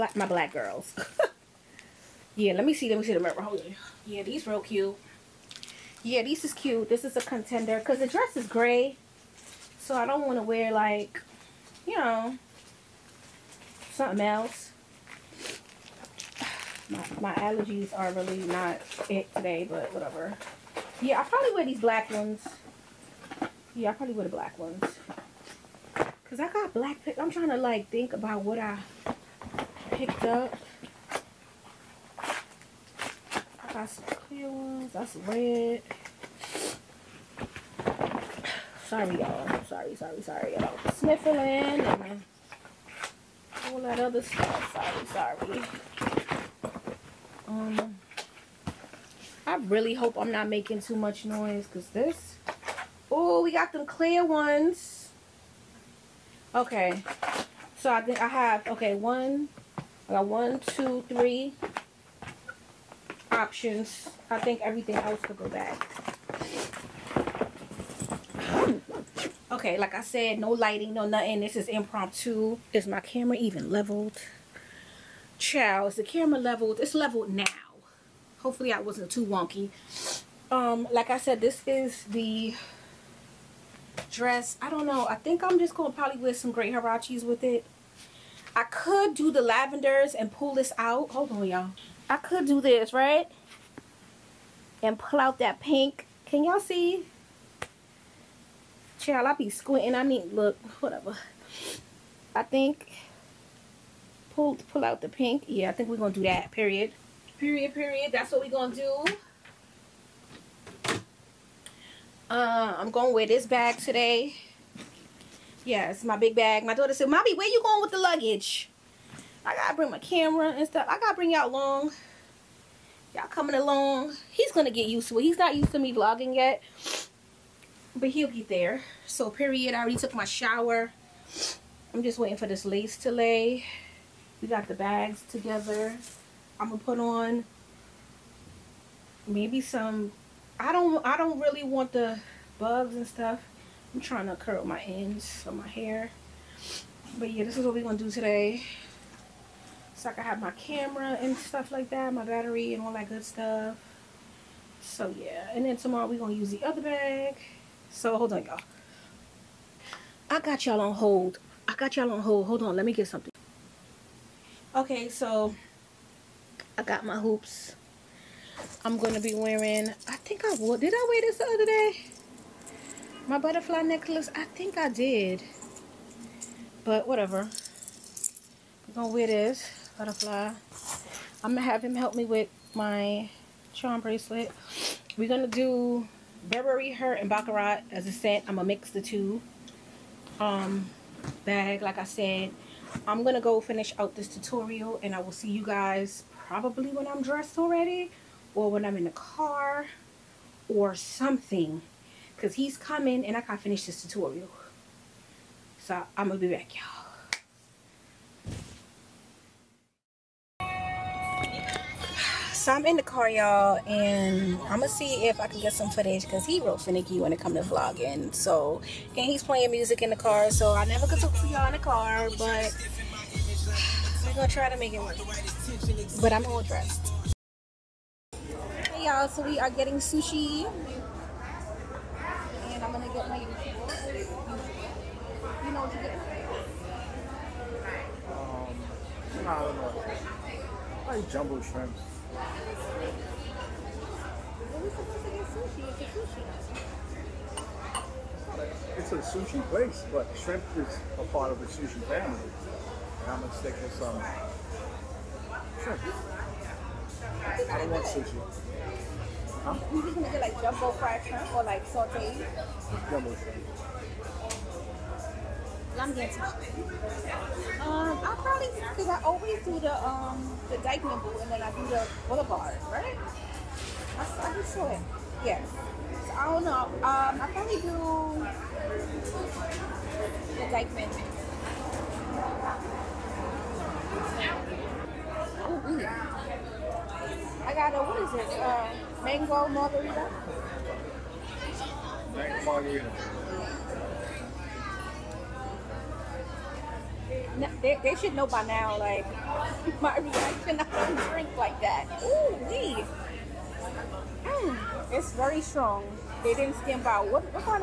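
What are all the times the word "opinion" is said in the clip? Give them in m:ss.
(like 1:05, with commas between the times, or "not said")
not said.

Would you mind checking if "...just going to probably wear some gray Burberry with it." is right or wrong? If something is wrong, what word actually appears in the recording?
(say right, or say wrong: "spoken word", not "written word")
wrong: "Hirachis", not "Burberry".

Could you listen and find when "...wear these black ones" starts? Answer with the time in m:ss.
0:21.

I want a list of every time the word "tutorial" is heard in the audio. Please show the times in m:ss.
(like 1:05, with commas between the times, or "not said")
3:14, 3:24.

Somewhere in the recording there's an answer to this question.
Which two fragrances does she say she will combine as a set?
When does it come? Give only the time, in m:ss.
3:06.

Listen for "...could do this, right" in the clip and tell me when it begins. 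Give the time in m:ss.
1:32.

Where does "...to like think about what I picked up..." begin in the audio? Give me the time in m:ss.
0:27.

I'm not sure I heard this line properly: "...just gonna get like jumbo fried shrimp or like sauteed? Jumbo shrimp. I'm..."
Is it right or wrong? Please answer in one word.
right.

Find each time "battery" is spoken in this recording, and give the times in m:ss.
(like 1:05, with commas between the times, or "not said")
2:32.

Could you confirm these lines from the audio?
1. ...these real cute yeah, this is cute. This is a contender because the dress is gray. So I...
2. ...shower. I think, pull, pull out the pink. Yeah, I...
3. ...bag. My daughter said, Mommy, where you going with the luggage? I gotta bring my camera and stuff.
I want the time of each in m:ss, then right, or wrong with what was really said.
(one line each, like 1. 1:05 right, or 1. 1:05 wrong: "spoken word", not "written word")
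1. 0:04 right
2. 1:40 wrong: "whatever", not "shower"
3. 1:56 right.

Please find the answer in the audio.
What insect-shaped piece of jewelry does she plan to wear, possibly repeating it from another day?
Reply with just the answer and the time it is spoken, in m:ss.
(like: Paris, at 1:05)
butterfly necklace, at 2:53.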